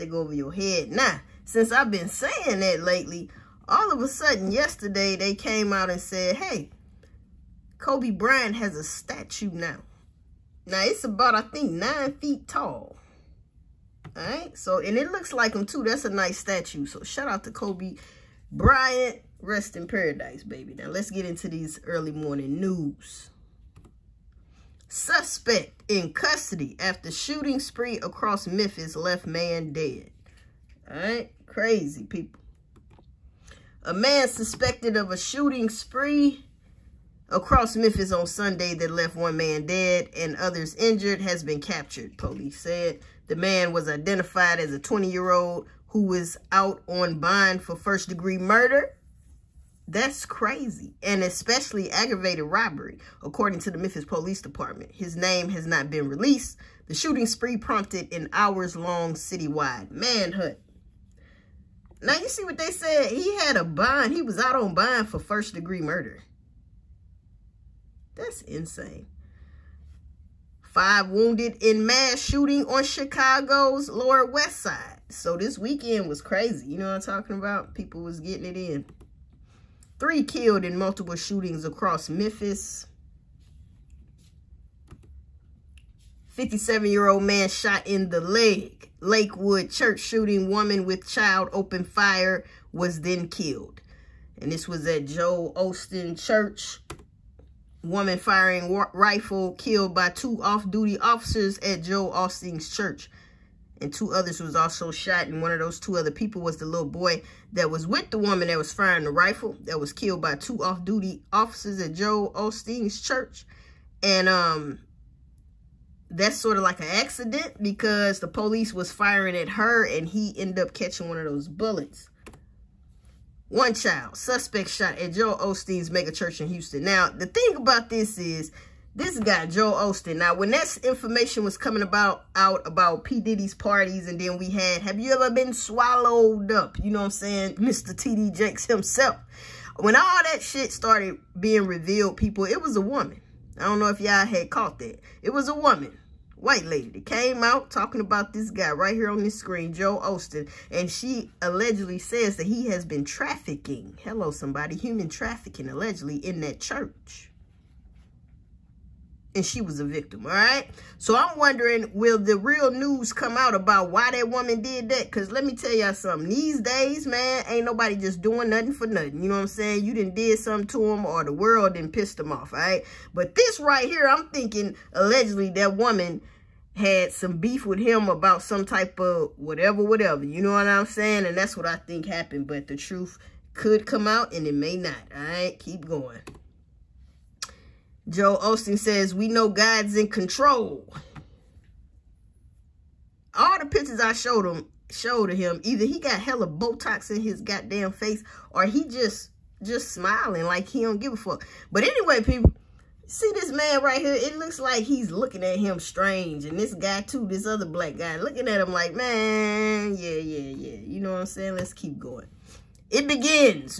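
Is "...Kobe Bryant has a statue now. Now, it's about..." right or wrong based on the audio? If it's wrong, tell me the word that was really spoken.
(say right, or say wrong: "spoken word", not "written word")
right.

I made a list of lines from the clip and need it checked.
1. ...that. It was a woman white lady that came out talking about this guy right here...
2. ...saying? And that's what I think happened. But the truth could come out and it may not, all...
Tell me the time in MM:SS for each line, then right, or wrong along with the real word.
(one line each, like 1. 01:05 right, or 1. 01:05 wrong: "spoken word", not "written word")
1. 02:24 right
2. 03:00 right.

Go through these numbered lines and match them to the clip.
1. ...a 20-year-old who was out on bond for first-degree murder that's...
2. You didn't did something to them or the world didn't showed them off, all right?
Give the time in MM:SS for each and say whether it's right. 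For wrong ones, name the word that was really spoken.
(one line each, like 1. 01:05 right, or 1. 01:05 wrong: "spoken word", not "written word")
1. 00:44 right
2. 02:49 wrong: "pissed", not "showed".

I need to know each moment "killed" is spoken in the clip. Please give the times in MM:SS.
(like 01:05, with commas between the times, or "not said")
01:20, 01:33, 01:39, 01:49.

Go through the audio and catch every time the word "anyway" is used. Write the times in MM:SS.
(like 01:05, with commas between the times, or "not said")
03:21.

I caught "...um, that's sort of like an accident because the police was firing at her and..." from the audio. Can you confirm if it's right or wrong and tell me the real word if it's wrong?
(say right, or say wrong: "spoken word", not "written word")
right.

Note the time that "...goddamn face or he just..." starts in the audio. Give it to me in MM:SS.
03:17.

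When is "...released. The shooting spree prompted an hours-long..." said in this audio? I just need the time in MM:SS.
00:56.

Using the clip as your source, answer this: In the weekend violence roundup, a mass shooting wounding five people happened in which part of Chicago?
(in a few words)
Lower West Side.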